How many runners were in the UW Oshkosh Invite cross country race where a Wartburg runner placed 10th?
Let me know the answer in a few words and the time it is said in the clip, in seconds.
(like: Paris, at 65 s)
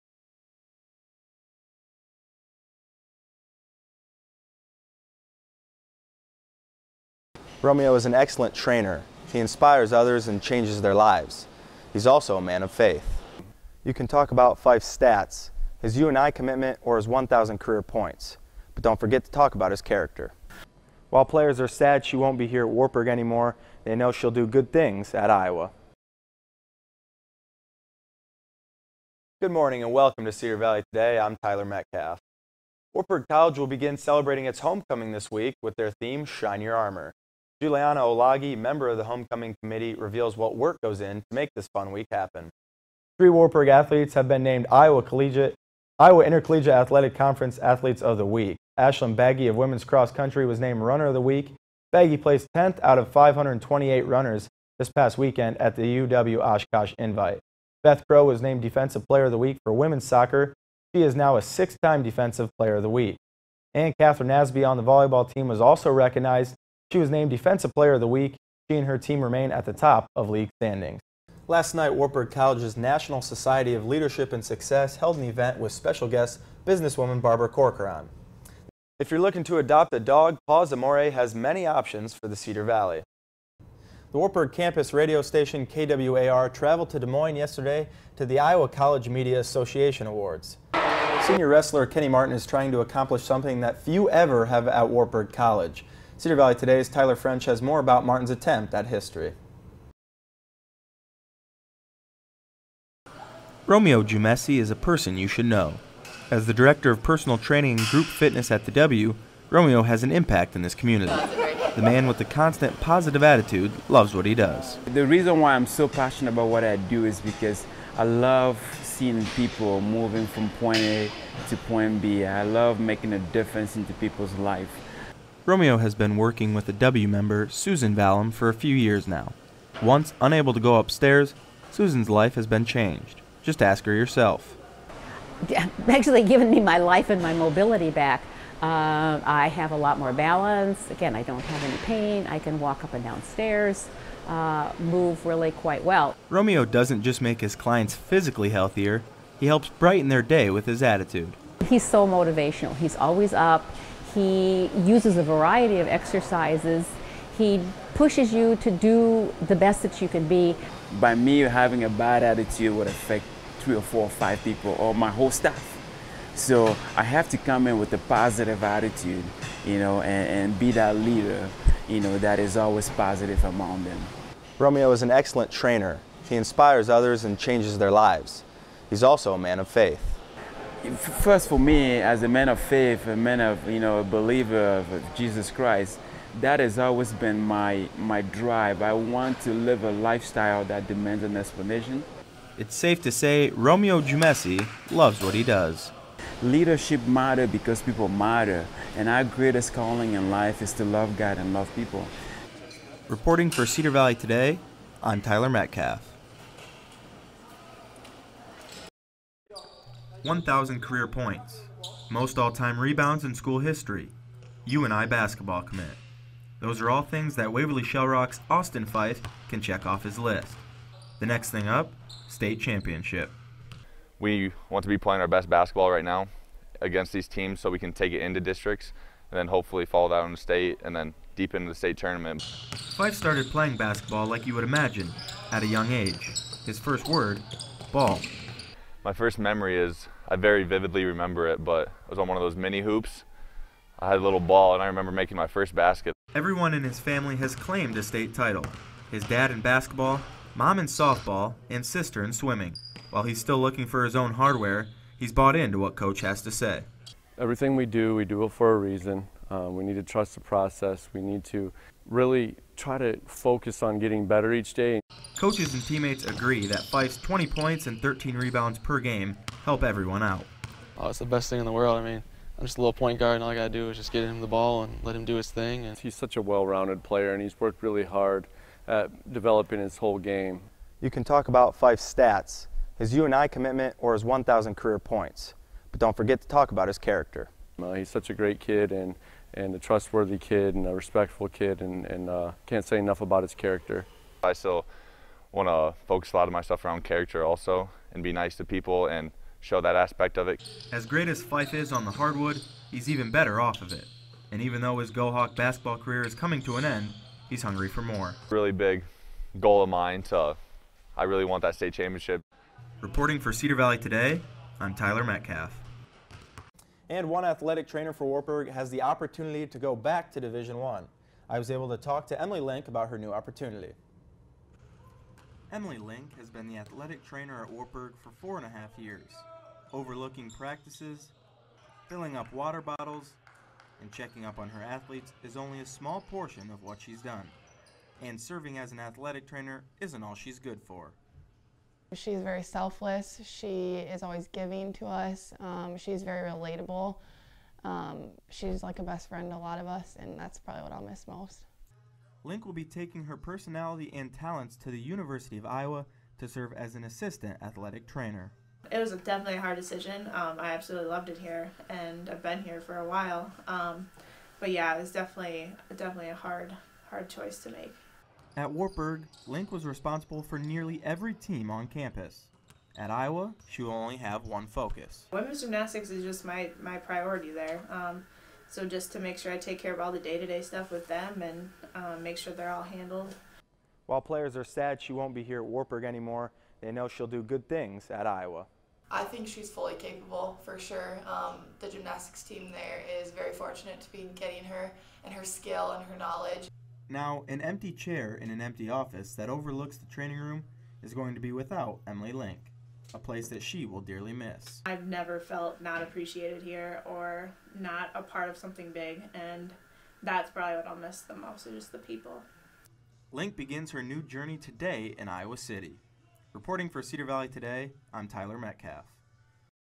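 528, at 53 s.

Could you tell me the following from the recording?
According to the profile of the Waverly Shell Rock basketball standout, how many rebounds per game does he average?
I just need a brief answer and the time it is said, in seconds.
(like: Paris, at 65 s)
13, at 268 s.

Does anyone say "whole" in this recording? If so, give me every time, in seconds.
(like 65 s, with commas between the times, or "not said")
165 s, 279 s.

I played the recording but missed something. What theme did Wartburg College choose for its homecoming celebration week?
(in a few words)
Shine Your Armor.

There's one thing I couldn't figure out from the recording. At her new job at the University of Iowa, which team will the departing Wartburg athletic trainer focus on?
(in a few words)
Women's gymnastics.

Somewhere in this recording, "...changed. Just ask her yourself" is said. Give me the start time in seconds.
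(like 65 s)
132 s.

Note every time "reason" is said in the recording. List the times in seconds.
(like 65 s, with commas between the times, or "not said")
115 s, 258 s.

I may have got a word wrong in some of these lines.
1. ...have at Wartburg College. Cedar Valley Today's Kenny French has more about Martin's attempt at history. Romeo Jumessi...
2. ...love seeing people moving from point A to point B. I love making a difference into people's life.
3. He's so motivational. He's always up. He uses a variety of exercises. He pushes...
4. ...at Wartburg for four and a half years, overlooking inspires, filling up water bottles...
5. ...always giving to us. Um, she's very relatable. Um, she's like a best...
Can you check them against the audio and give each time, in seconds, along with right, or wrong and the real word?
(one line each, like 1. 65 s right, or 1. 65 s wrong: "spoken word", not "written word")
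1. 94 s wrong: "Tyler", not "Kenny"
2. 118 s right
3. 151 s right
4. 327 s wrong: "practices", not "inspires"
5. 344 s right.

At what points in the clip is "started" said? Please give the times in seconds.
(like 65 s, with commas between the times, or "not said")
233 s.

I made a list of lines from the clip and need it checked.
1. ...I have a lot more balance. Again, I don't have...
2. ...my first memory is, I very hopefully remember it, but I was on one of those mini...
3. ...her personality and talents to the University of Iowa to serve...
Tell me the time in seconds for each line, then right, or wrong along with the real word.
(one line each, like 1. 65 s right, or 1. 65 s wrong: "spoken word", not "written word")
1. 139 s right
2. 239 s wrong: "vividly", not "hopefully"
3. 353 s right.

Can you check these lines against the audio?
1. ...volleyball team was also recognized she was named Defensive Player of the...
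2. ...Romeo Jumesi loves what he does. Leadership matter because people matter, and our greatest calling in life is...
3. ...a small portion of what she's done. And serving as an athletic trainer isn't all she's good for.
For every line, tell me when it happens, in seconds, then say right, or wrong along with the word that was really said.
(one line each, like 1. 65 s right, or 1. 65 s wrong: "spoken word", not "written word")
1. 64 s right
2. 193 s right
3. 335 s right.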